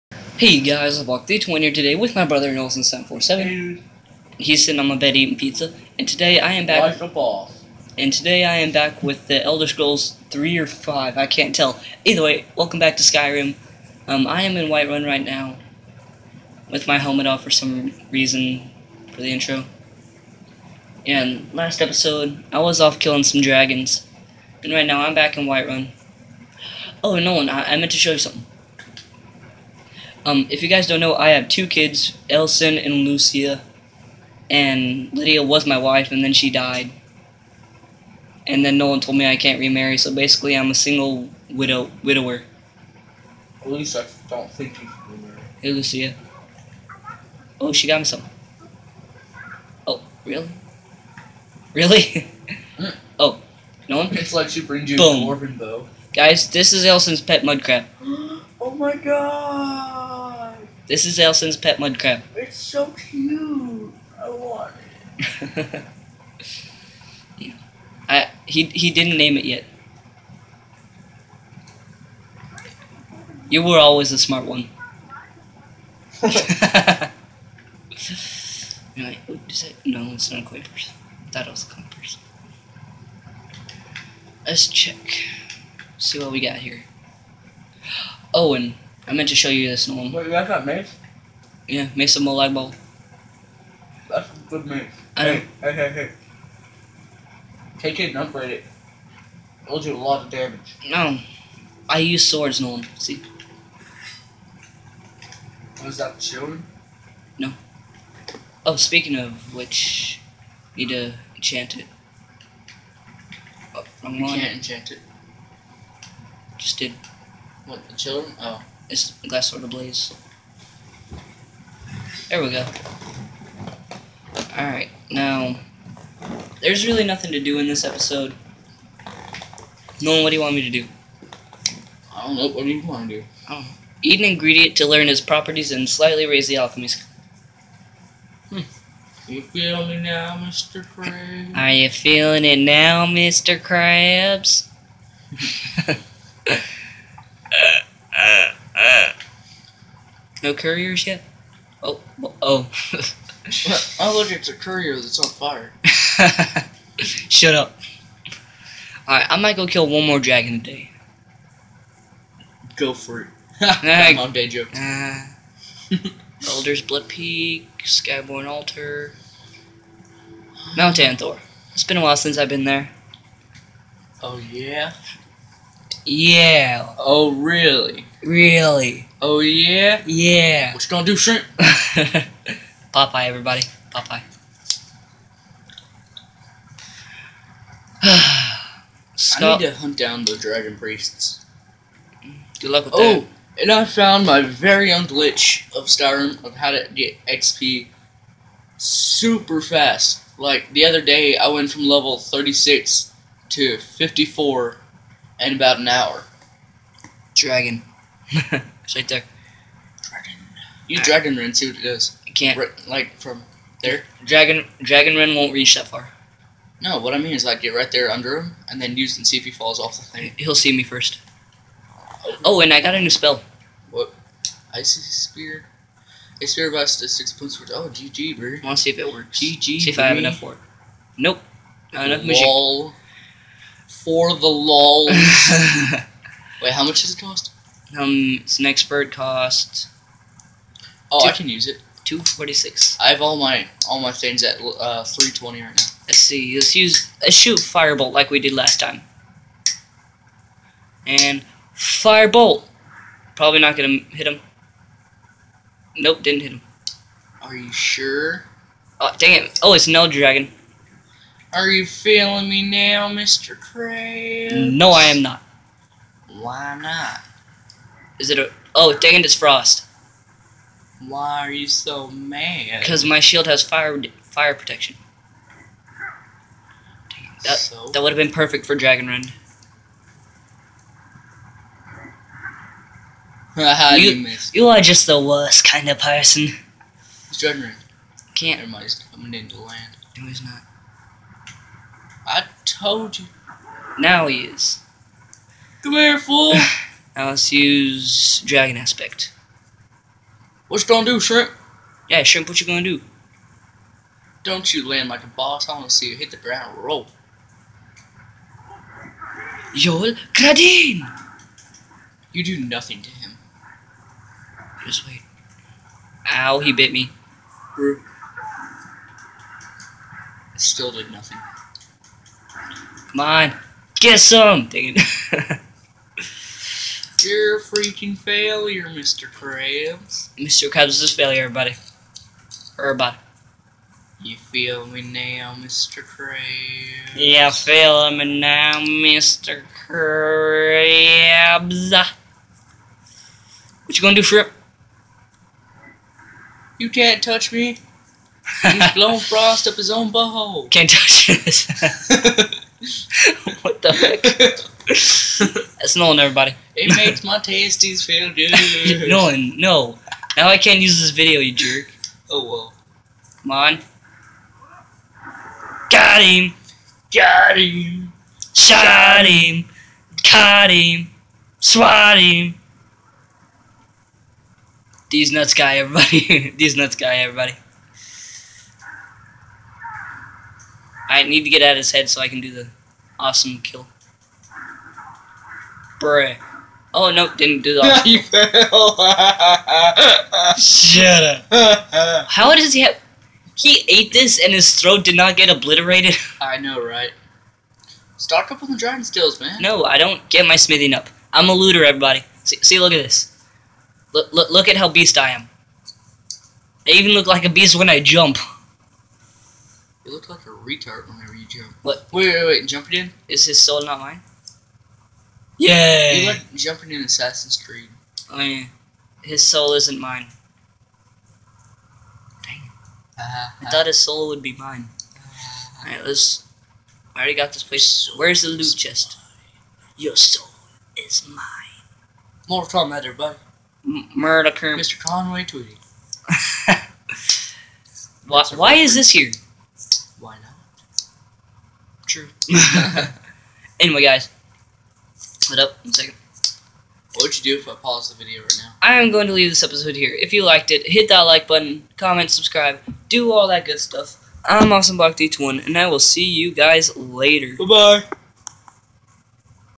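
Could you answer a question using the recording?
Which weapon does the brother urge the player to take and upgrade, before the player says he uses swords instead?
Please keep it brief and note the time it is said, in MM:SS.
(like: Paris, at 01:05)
Mace of Molag Bal, at 01:31.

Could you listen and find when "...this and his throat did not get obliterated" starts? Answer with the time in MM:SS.
06:34.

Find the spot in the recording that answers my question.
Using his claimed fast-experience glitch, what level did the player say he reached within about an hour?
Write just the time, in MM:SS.
03:23.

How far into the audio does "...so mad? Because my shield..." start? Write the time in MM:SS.
04:31.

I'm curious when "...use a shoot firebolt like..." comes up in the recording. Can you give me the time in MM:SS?
04:06.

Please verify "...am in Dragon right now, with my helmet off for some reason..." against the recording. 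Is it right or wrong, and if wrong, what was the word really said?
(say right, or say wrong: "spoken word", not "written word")
wrong: "Whiterun", not "Dragon".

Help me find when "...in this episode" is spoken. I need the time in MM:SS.
02:07.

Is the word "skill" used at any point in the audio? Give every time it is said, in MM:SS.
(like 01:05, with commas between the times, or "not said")
02:16, 06:39.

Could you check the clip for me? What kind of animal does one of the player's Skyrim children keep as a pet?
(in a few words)
mud crab.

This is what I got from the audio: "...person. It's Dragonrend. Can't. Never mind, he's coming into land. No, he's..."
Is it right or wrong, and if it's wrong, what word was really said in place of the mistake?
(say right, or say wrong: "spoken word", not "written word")
right.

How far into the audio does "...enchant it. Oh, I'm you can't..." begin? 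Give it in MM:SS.
01:51.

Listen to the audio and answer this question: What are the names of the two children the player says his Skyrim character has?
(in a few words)
Alesan and Lucia.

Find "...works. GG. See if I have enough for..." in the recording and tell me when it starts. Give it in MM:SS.
03:49.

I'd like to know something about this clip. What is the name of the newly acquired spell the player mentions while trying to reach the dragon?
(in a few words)
Icy Spear.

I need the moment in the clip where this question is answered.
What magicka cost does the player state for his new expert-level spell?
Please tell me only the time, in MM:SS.
04:02.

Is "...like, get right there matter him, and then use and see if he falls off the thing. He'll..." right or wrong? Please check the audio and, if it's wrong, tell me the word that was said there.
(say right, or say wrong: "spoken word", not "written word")
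wrong: "under", not "matter".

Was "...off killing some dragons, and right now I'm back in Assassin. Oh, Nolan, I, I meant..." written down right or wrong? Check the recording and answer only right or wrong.
wrong.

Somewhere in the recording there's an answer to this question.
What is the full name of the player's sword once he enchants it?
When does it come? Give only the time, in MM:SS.
01:59.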